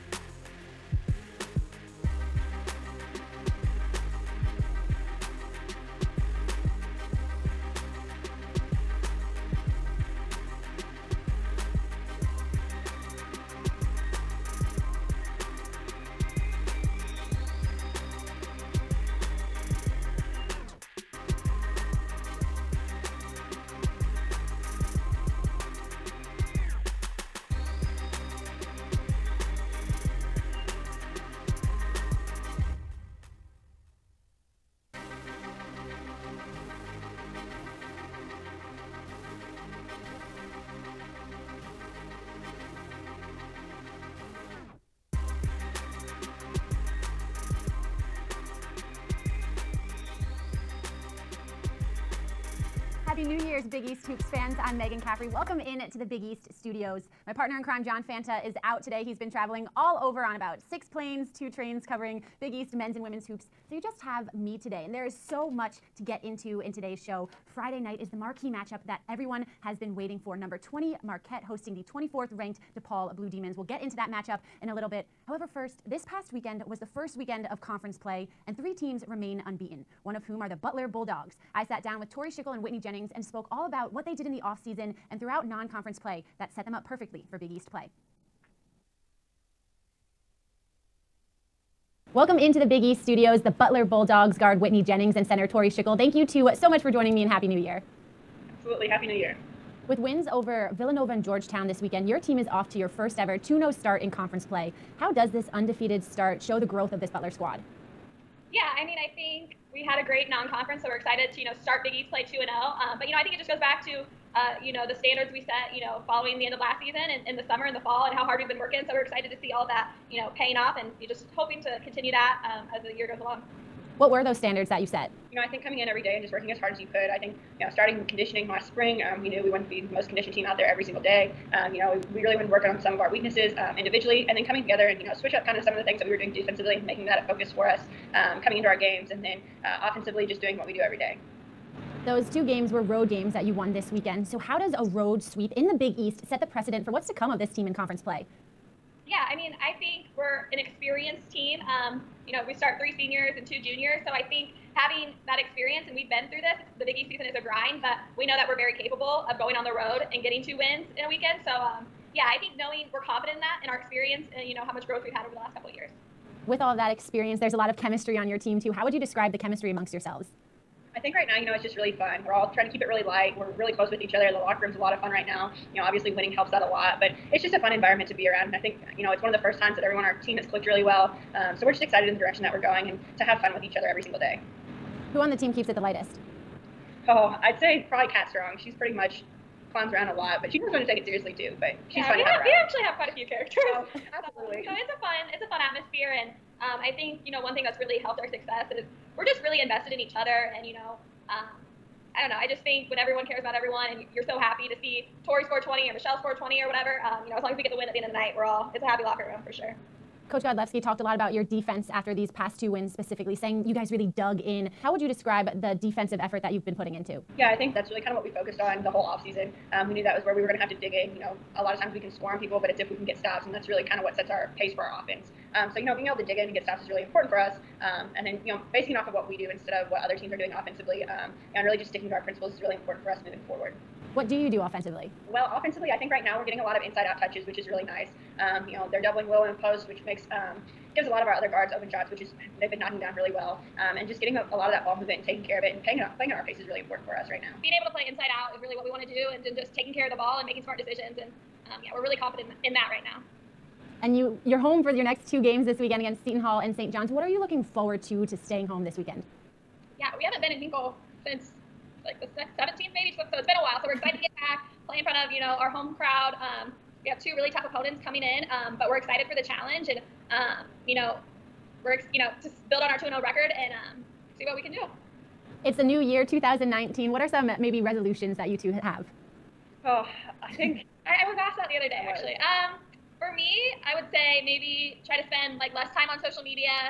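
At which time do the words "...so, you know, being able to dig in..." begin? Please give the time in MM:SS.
03:45.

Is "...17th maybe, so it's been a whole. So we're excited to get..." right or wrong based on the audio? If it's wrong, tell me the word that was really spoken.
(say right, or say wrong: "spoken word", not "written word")
wrong: "while", not "whole".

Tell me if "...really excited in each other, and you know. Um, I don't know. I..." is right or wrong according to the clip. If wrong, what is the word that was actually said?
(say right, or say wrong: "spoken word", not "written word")
wrong: "invested", not "excited".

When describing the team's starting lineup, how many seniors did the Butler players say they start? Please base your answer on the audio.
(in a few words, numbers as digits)
3.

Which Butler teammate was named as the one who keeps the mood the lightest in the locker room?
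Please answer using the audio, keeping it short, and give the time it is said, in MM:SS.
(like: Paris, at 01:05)
Kat Strong, at 03:08.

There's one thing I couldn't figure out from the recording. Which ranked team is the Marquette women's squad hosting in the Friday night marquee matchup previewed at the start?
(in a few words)
DePaul Blue Demons.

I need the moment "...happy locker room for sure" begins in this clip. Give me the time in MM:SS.
03:28.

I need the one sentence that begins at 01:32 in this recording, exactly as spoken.
Welcome into the Big East studios, the Butler Bulldogs guard Whitney Jennings and center Tori Schickel.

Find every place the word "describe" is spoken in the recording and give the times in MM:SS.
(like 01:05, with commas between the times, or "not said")
02:48, 03:35.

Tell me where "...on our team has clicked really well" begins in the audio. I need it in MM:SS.
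03:00.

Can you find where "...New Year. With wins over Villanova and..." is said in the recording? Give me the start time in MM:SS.
01:39.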